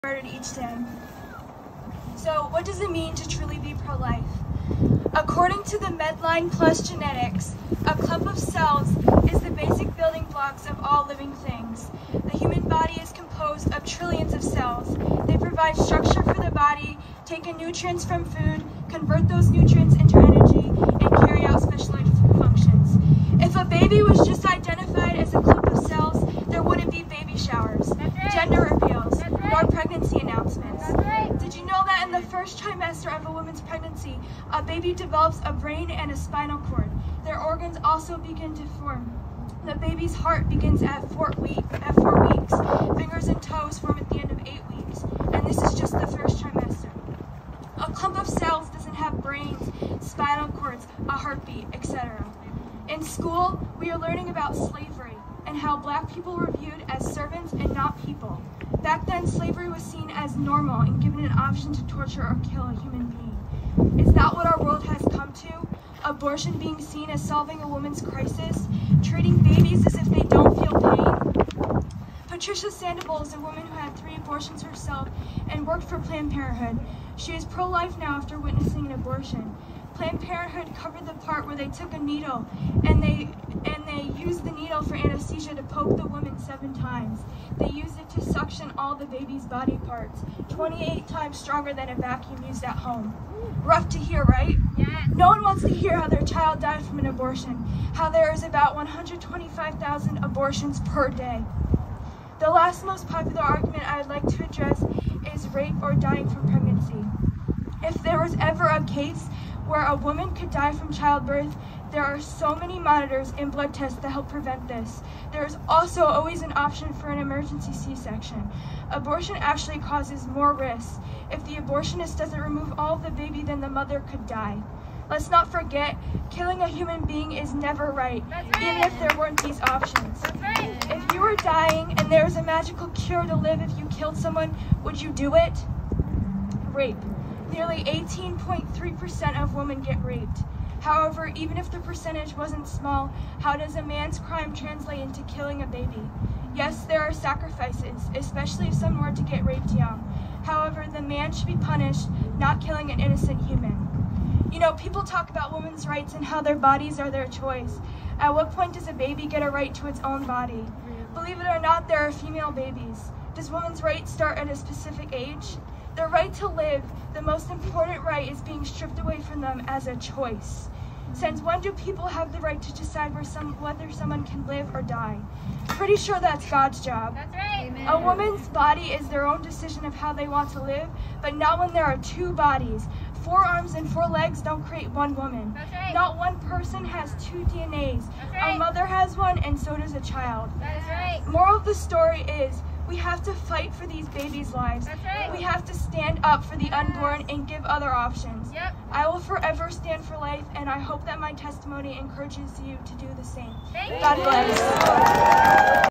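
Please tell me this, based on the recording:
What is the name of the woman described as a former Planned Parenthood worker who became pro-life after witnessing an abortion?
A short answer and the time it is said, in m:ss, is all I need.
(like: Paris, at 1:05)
Patricia Sandoval, at 1:12.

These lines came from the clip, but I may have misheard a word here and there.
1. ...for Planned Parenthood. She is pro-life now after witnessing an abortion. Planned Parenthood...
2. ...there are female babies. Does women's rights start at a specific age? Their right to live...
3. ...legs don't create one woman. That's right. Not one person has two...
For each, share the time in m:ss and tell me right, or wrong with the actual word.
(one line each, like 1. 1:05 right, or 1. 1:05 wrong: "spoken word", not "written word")
1. 1:15 right
2. 2:41 right
3. 3:04 right.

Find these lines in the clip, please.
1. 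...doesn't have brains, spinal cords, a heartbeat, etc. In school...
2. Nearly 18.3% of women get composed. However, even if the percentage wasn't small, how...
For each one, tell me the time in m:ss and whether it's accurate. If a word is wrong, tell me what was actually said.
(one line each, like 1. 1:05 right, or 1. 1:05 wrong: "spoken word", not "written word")
1. 0:48 right
2. 2:17 wrong: "raped", not "composed".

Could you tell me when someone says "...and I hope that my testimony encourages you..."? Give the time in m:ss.
3:20.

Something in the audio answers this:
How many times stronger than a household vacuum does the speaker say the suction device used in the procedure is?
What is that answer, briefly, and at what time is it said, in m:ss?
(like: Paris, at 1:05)
28, at 1:30.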